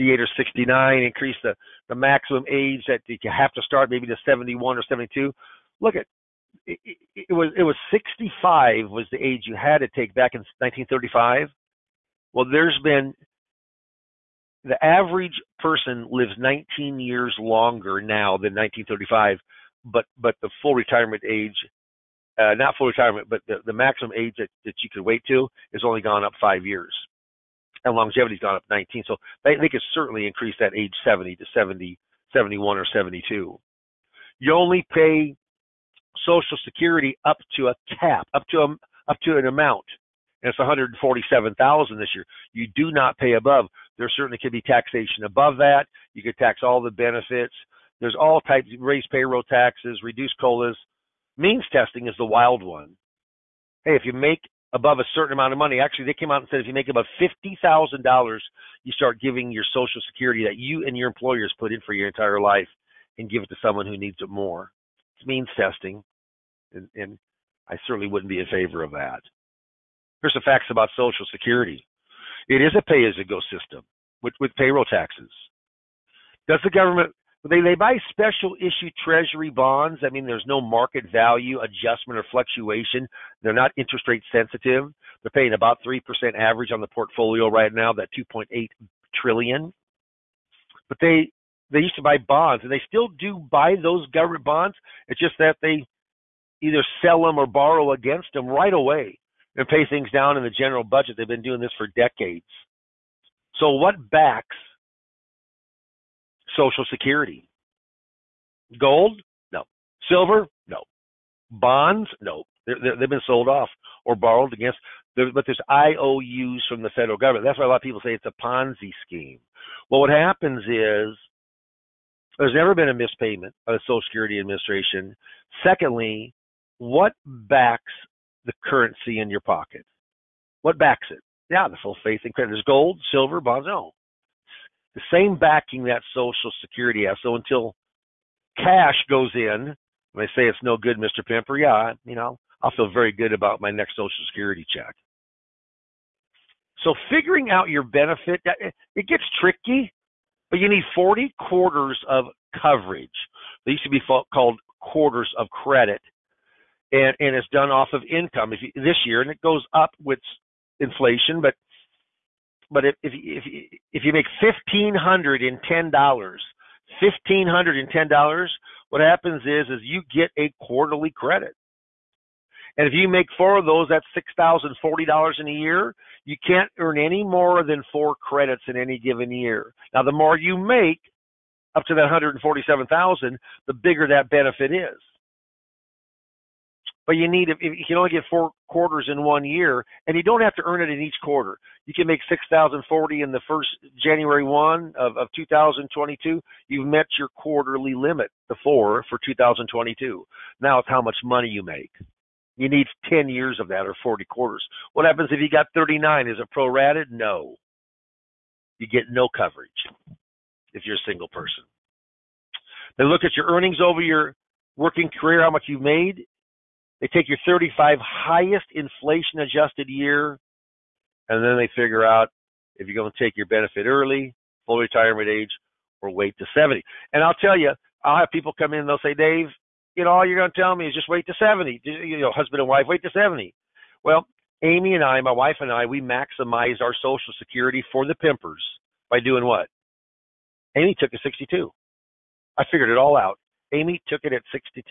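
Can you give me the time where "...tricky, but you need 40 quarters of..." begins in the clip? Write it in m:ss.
2:29.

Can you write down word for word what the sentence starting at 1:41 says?
They've been doing this for decades.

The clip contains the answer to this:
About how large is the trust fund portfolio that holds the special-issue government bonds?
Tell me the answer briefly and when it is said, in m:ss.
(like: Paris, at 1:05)
2.8 trillion, at 1:28.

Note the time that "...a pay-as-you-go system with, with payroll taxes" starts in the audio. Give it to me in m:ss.
1:12.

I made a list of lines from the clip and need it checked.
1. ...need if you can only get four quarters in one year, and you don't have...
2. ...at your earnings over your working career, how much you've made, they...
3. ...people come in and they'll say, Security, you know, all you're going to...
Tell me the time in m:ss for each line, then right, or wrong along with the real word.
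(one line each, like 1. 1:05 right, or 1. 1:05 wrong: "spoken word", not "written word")
1. 3:07 right
2. 3:33 right
3. 3:48 wrong: "Dave", not "Security".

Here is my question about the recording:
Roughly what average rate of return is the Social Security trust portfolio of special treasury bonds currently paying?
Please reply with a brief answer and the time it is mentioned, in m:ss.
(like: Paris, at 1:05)
3%, at 1:25.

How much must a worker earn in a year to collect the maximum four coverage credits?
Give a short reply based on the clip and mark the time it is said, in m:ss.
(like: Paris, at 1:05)
$6,040, at 2:54.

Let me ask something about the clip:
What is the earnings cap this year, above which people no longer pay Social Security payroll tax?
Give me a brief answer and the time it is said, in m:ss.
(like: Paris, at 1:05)
$147,000, at 0:40.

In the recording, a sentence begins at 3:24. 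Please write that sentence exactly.
What happens if you got thirty nine?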